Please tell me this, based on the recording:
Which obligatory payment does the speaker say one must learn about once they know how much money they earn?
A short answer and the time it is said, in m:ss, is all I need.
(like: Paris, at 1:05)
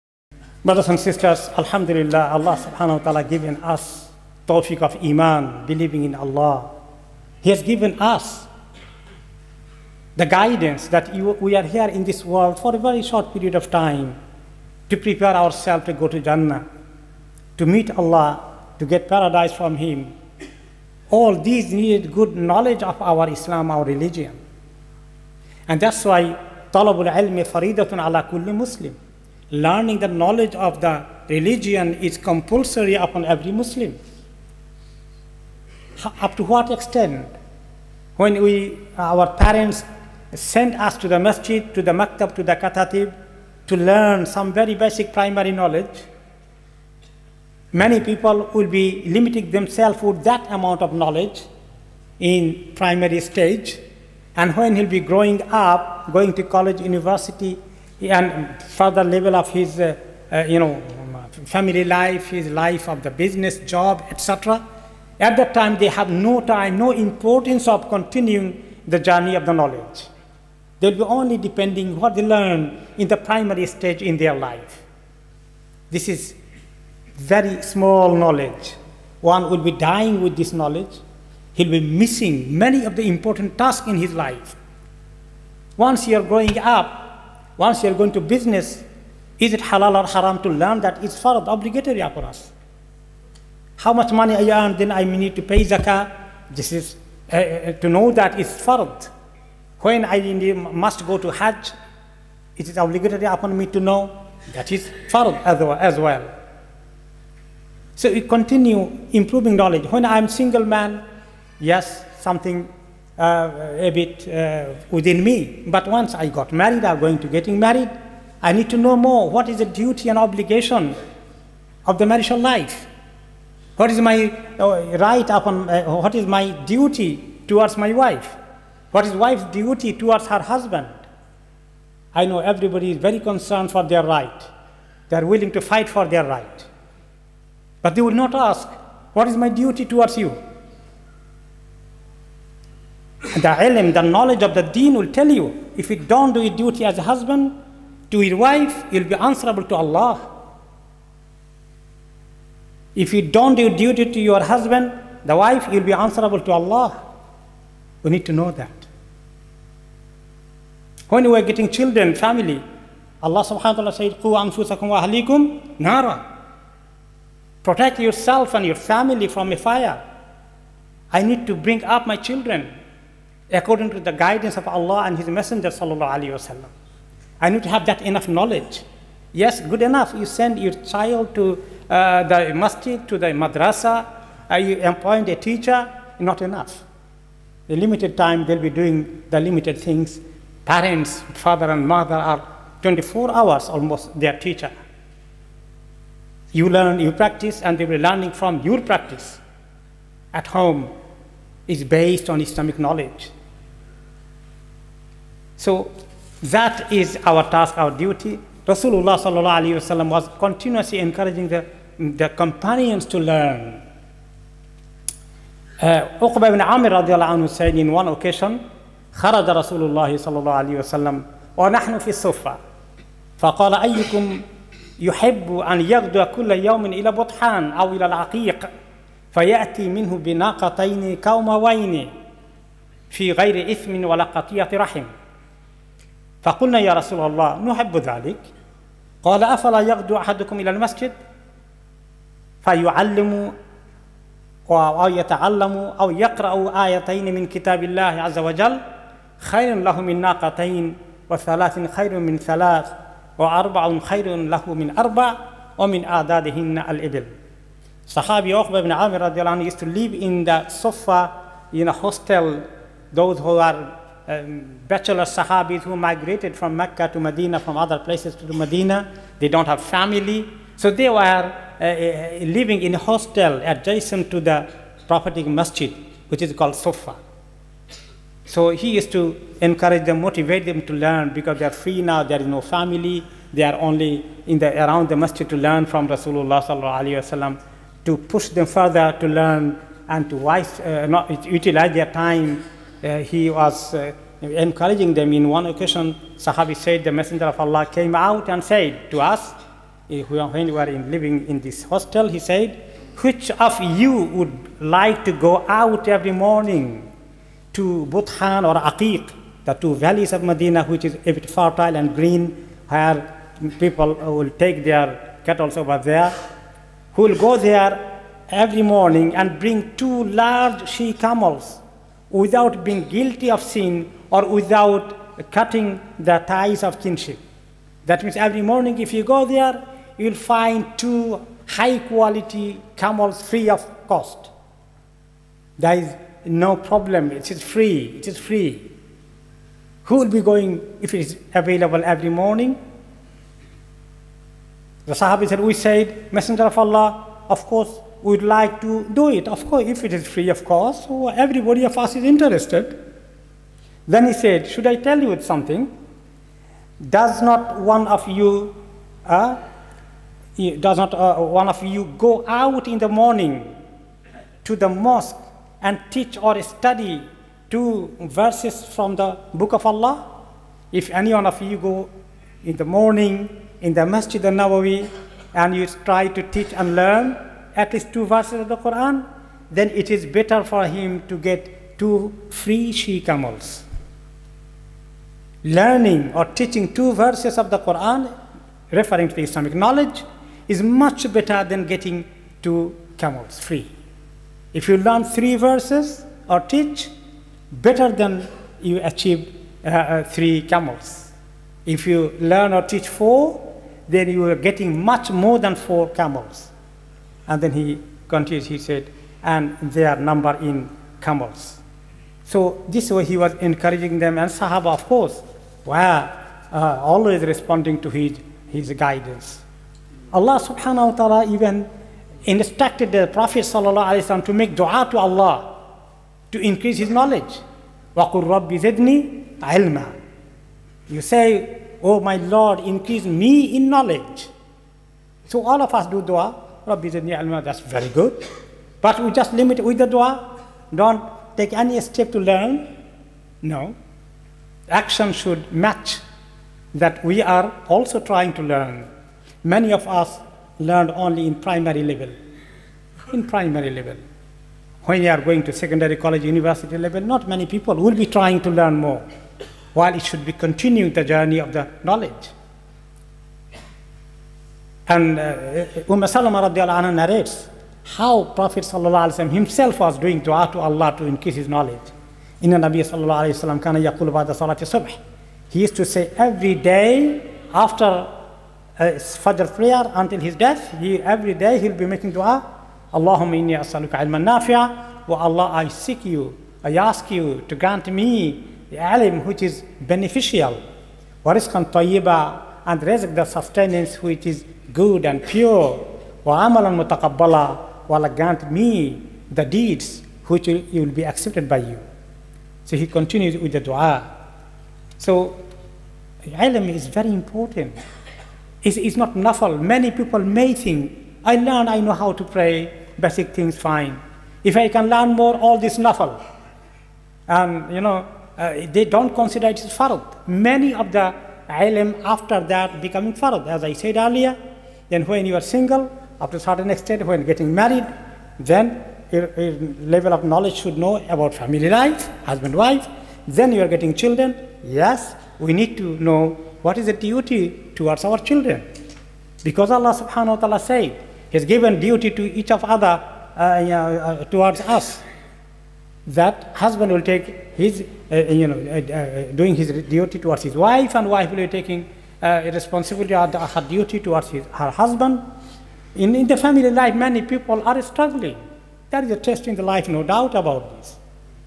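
Zakah, at 1:35.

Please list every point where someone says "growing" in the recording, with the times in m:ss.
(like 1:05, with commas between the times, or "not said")
0:54, 1:26.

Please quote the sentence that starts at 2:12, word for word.
I know everybody is very concerned for their right.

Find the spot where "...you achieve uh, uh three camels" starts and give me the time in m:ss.
6:38.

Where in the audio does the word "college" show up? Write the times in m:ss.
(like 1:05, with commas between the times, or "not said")
0:56, 7:36.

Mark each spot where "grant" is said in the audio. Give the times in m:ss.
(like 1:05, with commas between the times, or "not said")
8:07, 8:18.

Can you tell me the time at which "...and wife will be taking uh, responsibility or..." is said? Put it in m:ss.
9:11.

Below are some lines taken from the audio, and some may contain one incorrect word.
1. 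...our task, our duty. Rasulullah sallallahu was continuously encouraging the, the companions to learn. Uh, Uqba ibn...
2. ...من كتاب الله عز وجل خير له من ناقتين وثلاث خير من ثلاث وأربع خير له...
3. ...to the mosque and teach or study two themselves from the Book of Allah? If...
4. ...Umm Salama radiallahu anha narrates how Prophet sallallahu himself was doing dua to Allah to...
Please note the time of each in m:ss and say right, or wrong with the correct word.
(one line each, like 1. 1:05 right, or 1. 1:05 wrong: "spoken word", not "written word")
1. 3:27 right
2. 4:07 right
3. 6:04 wrong: "verses", not "themselves"
4. 7:46 right.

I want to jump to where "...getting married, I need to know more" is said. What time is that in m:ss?
1:57.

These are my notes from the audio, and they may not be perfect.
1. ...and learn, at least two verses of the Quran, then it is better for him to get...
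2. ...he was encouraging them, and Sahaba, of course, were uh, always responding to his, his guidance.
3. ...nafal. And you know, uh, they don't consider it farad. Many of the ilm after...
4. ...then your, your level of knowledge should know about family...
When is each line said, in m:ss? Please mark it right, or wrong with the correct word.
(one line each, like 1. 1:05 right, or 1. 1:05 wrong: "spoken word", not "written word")
1. 6:16 right
2. 6:53 right
3. 8:35 right
4. 8:48 right.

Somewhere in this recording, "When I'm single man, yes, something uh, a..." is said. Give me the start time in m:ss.
1:49.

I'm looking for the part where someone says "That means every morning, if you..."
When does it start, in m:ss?
5:28.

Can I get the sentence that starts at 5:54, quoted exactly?
Then he said, should I tell you something?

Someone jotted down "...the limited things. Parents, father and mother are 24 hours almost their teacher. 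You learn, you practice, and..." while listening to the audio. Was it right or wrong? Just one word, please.
right.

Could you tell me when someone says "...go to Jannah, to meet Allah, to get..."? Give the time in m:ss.
0:15.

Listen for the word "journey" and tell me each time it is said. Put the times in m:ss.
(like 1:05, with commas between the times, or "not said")
1:08, 7:41.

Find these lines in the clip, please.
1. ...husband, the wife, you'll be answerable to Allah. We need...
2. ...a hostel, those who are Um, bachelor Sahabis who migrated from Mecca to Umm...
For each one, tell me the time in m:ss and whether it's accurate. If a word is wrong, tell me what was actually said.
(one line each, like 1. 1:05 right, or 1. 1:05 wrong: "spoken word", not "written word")
1. 2:34 right
2. 4:21 wrong: "Medina", not "Umm".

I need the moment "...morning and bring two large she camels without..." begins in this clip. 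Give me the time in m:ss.
5:18.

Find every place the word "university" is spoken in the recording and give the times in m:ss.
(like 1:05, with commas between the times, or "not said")
0:56, 7:36.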